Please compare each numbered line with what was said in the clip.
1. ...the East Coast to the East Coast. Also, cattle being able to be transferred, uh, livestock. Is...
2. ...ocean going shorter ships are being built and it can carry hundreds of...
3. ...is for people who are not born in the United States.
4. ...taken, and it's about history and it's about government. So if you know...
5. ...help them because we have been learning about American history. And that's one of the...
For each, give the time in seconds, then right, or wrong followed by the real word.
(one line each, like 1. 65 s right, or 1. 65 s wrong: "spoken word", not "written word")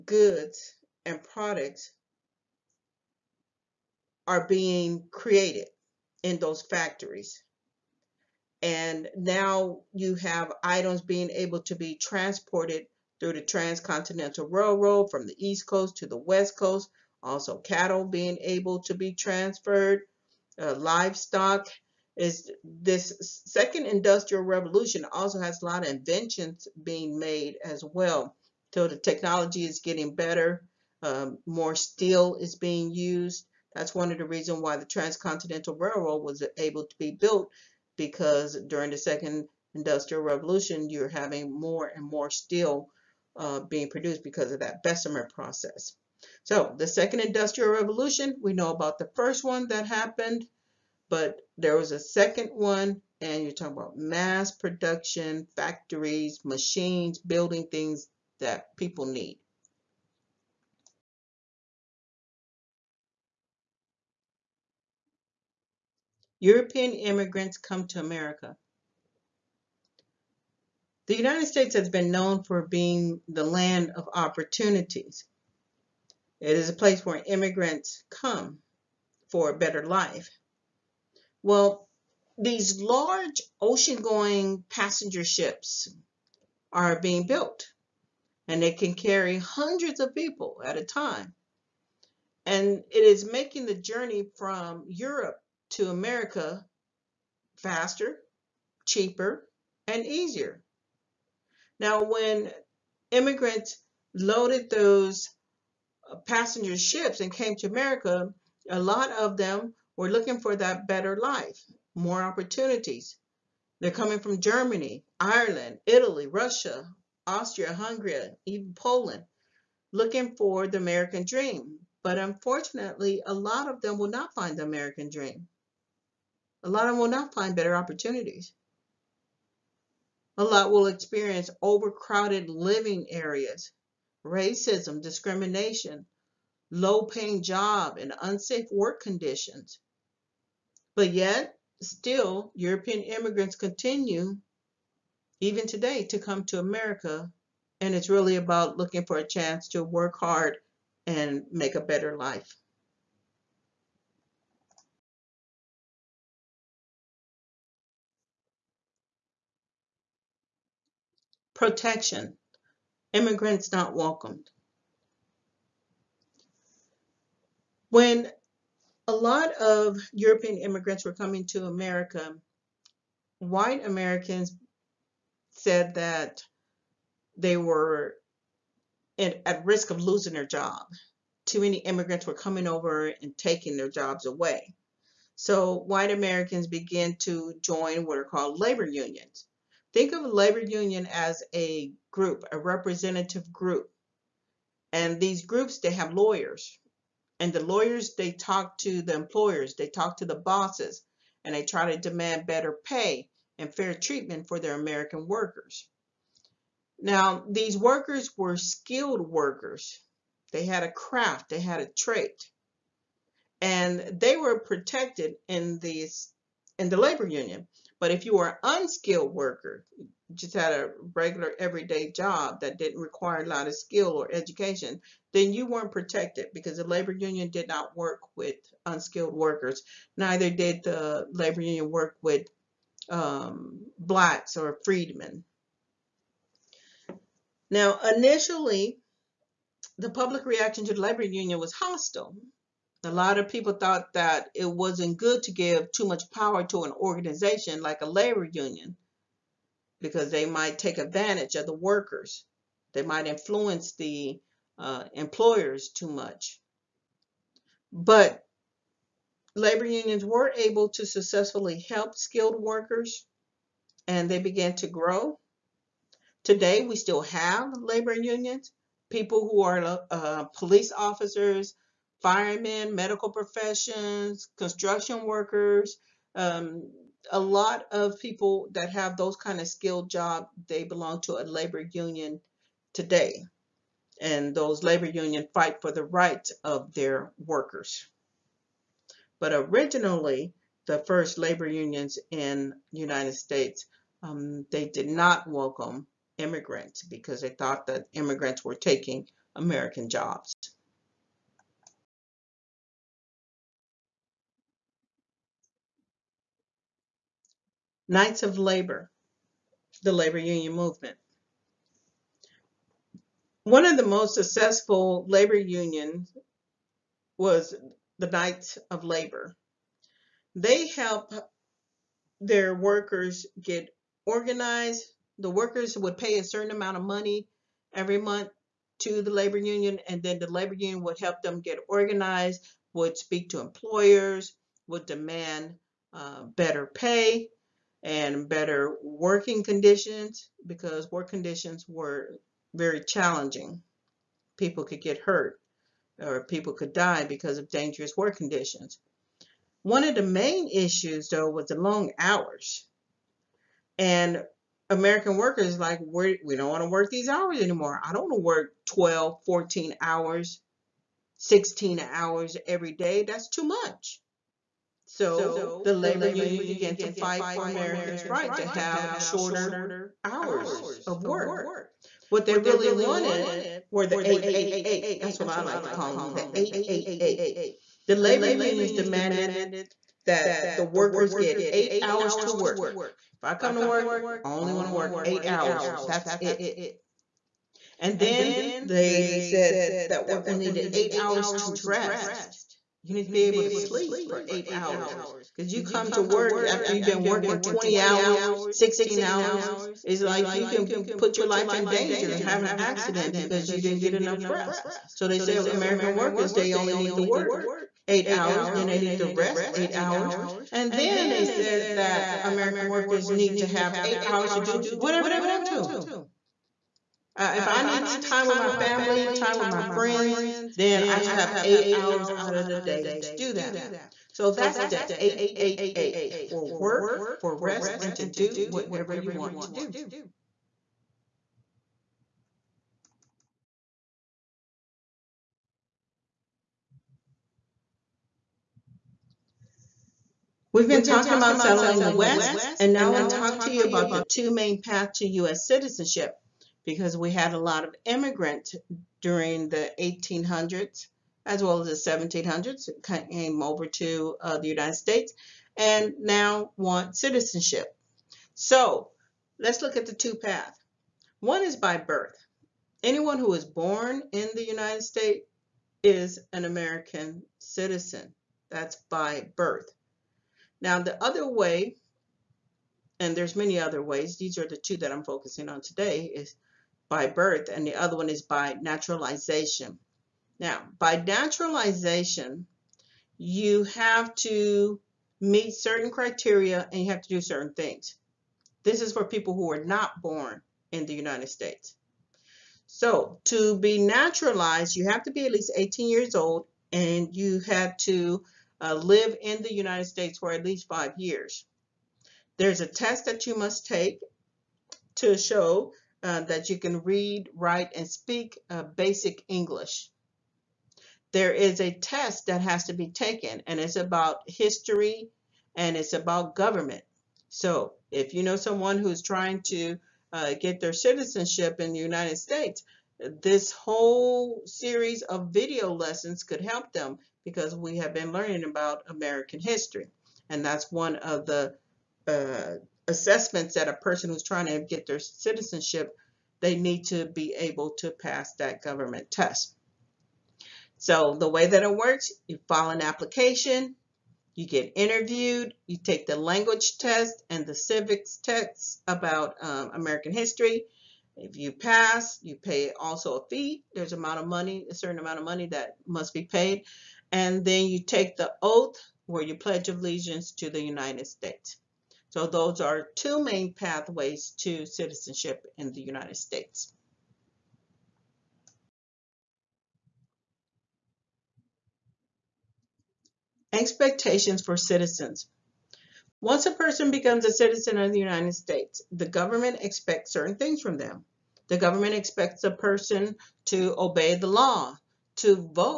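1. 15 s wrong: "West", not "East"
2. 83 s wrong: "passenger", not "shorter"
3. 489 s right
4. 513 s right
5. 526 s right.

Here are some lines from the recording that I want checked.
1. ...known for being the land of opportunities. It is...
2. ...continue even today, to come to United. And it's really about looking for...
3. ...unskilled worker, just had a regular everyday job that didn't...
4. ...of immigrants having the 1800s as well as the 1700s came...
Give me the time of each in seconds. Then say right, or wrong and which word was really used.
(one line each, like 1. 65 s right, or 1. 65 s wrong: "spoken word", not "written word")
1. 72 s right
2. 143 s wrong: "America", not "United"
3. 218 s right
4. 447 s wrong: "during", not "having".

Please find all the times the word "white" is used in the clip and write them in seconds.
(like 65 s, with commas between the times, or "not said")
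173 s, 185 s.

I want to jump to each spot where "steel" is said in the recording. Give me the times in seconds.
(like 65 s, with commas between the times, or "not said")
31 s, 42 s.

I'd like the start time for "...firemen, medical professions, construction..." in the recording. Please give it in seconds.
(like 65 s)
272 s.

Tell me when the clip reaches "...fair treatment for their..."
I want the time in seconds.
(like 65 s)
203 s.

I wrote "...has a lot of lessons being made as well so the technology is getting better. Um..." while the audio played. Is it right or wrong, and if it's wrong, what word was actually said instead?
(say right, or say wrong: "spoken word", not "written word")
wrong: "inventions", not "lessons".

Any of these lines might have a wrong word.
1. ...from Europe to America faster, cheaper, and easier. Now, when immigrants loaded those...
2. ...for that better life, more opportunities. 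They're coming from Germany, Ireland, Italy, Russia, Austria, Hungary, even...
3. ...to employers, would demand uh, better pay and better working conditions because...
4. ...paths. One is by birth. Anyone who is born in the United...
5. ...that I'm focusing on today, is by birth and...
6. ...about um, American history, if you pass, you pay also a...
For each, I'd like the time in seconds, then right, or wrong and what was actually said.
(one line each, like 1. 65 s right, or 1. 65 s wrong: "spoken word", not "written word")
1. 94 s right
2. 110 s right
3. 333 s right
4. 460 s right
5. 474 s right
6. 549 s right.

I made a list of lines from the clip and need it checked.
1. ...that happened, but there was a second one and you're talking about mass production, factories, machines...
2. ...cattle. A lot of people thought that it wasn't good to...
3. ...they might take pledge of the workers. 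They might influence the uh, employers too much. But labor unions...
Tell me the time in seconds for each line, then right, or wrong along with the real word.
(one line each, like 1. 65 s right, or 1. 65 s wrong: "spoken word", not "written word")
1. 49 s right
2. 241 s wrong: "hostile", not "cattle"
3. 250 s wrong: "advantage", not "pledge".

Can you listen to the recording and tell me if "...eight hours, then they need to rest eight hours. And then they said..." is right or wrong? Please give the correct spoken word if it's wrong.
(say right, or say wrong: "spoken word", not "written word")
right.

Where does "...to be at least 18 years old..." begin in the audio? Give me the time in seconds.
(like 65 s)
495 s.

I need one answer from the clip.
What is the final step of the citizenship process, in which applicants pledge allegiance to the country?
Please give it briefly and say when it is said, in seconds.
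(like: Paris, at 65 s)
the oath, at 558 s.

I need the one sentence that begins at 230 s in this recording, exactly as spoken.
Neither did the labor union work with um, blacks or freedmen.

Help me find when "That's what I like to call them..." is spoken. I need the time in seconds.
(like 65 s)
375 s.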